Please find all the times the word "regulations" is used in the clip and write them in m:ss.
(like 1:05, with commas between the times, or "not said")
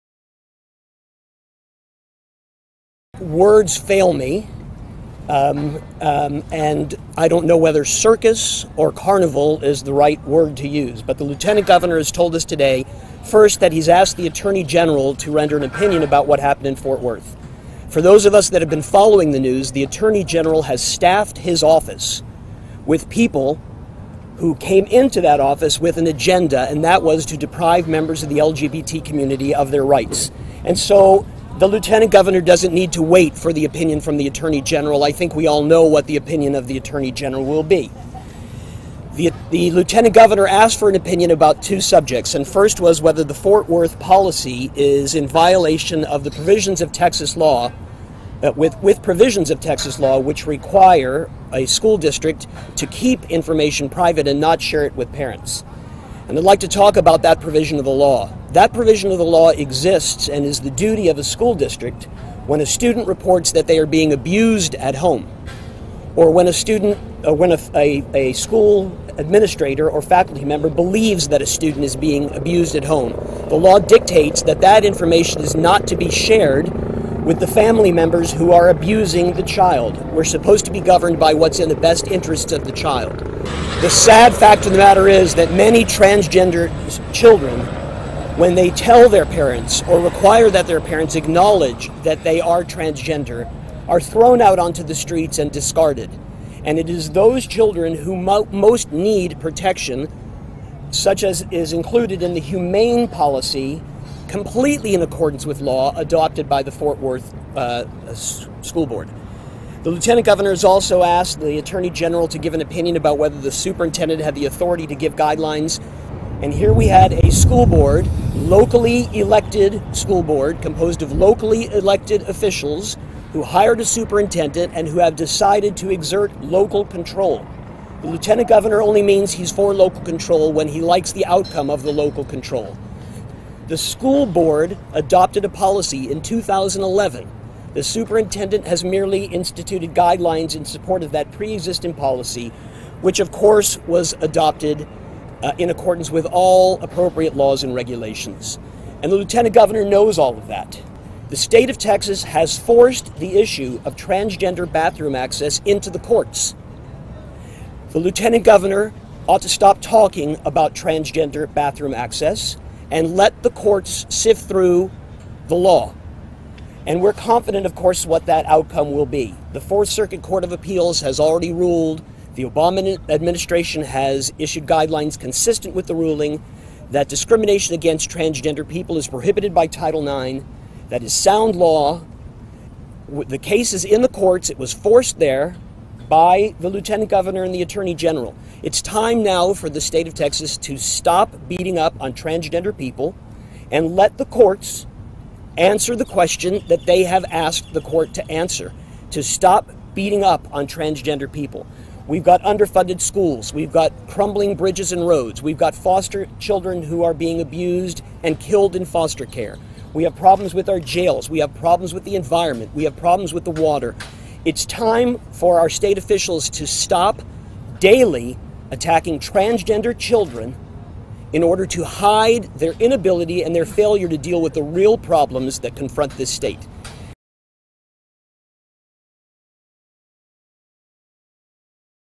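2:27.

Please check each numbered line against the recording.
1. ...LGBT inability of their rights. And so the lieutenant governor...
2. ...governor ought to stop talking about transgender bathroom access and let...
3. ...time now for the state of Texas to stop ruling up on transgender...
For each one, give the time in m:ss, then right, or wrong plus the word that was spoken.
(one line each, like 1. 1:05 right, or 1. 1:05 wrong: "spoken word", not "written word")
1. 0:28 wrong: "community", not "inability"
2. 2:38 right
3. 3:08 wrong: "beating", not "ruling".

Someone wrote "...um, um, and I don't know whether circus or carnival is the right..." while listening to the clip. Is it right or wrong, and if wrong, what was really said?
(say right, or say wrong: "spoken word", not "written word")
right.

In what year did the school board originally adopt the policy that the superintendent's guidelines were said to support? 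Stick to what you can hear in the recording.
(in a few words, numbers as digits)
2011.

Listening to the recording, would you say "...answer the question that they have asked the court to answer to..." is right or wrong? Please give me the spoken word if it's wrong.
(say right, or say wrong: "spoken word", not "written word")
right.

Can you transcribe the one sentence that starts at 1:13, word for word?
The law dictates that that information is not to be shared with the family members who are abusing the child.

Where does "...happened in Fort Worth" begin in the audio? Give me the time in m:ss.
0:16.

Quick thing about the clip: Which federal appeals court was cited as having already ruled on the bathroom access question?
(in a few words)
Fourth Circuit Court of Appeals.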